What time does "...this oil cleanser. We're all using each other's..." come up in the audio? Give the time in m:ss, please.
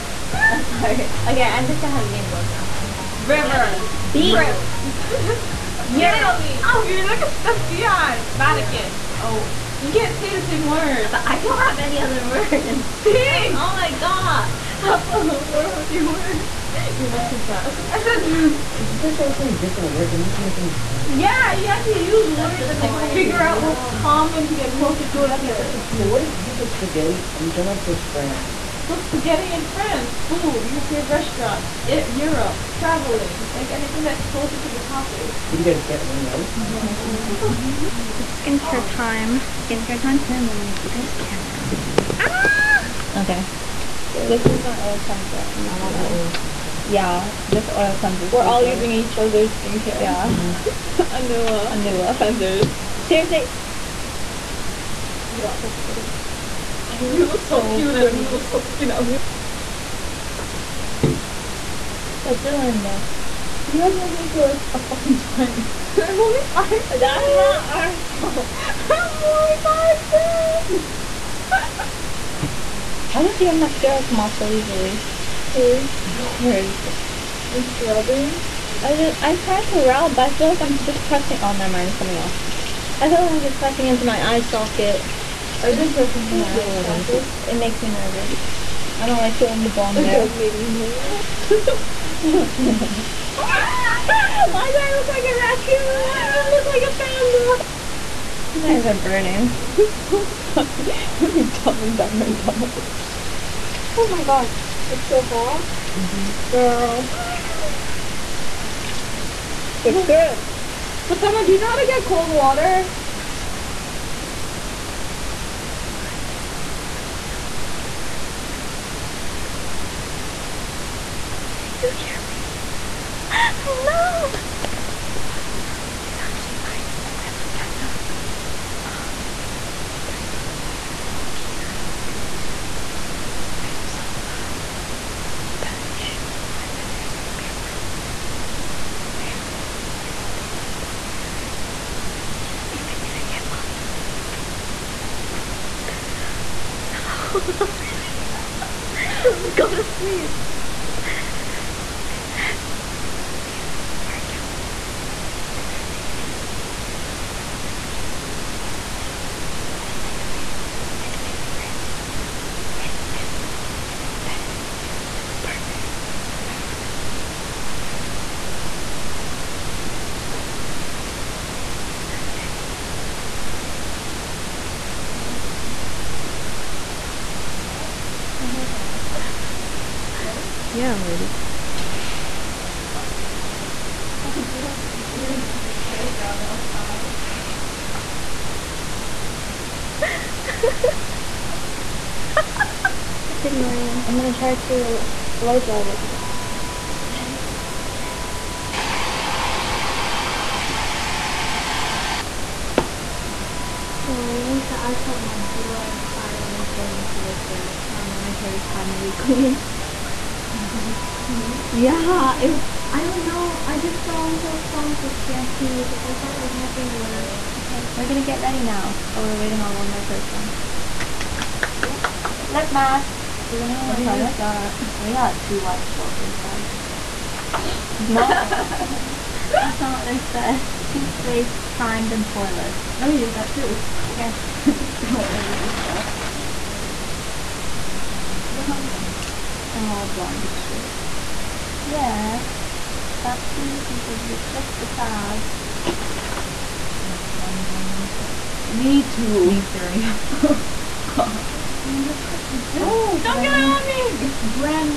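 0:47.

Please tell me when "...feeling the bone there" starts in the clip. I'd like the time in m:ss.
1:29.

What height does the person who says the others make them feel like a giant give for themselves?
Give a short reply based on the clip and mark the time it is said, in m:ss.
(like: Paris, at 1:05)
5'10", at 1:09.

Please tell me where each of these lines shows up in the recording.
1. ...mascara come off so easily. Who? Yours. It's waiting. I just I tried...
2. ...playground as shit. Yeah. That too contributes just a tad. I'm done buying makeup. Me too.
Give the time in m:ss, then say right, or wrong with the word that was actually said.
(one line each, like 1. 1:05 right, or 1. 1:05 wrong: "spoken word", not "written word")
1. 1:13 wrong: "rubbing", not "waiting"
2. 4:00 wrong: "blind", not "playground".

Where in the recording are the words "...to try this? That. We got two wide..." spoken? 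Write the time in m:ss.
3:43.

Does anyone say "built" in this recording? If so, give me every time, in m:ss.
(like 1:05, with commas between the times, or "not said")
not said.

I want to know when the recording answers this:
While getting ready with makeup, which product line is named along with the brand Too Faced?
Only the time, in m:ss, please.
3:51.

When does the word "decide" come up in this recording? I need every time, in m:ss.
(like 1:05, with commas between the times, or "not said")
not said.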